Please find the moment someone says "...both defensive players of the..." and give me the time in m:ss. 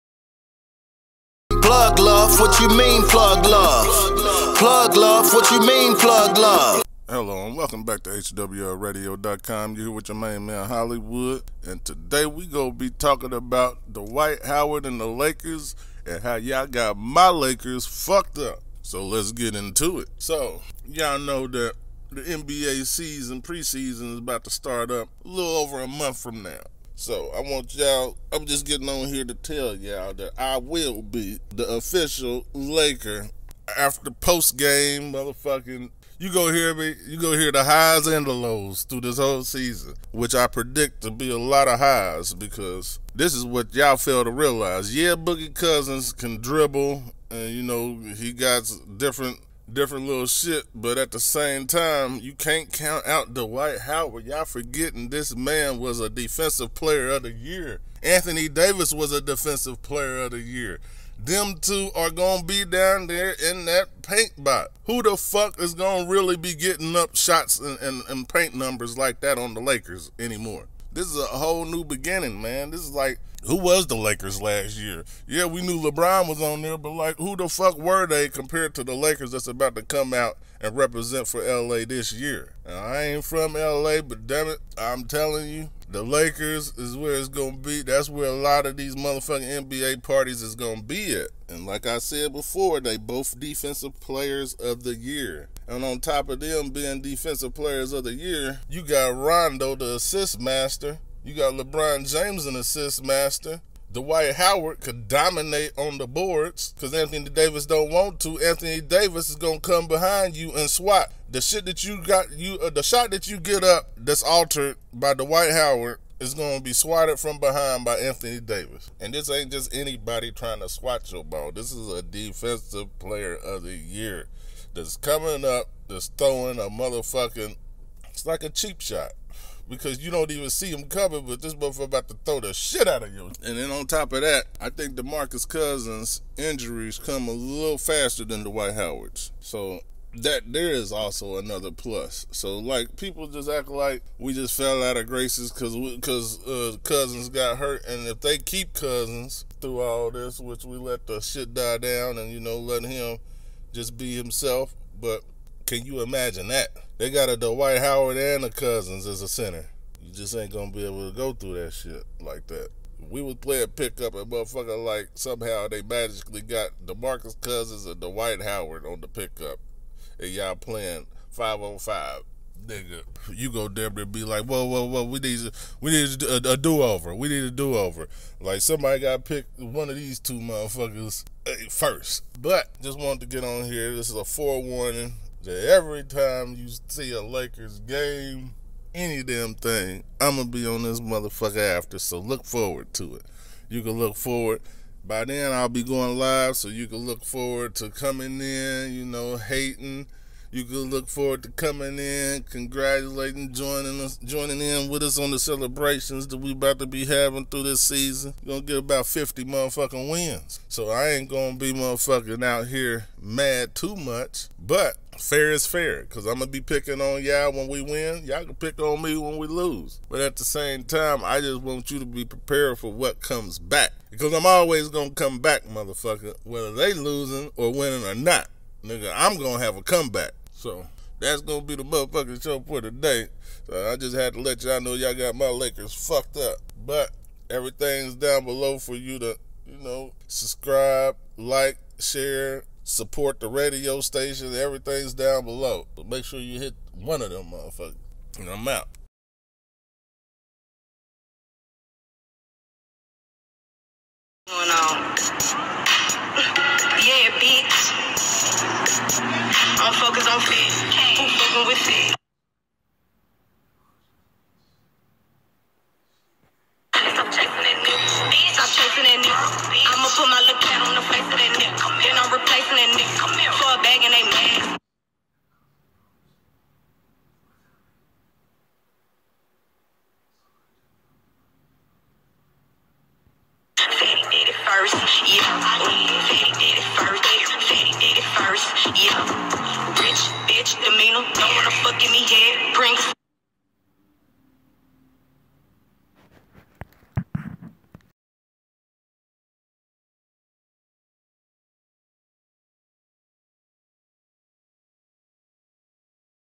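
1:32.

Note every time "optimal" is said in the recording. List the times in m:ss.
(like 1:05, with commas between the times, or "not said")
not said.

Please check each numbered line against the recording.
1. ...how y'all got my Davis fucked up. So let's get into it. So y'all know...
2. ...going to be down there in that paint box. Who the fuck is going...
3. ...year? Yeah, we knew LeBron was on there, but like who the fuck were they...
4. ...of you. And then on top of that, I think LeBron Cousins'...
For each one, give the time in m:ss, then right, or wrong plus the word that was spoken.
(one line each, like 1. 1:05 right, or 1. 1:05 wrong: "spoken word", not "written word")
1. 0:16 wrong: "Lakers", not "Davis"
2. 1:02 right
3. 1:14 right
4. 2:13 wrong: "DeMarcus", not "LeBron".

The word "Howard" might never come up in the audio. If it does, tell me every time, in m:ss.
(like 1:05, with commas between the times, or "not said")
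0:14, 0:53, 1:44, 1:55, 2:18, 2:37, 2:48.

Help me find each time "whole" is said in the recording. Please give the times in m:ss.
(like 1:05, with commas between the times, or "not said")
0:39, 1:11.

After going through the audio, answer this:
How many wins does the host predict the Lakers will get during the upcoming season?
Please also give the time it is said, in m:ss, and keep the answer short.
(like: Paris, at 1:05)
50, at 3:29.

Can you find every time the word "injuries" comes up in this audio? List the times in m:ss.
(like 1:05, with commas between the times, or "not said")
2:16.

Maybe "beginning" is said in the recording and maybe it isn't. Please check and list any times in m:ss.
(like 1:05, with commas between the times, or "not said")
1:11.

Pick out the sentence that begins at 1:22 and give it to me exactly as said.
Now, I ain't from LA, but damn it, I'm telling you, the Lakers is where it's gonna be.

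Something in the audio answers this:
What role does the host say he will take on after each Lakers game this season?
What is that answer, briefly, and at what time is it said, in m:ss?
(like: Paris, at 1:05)
Official Laker after post game, at 0:31.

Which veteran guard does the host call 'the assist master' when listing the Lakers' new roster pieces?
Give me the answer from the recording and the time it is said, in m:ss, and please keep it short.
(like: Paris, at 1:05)
Rondo, at 1:39.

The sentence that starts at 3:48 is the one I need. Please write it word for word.
Nigga, I'm gonna have a comeback.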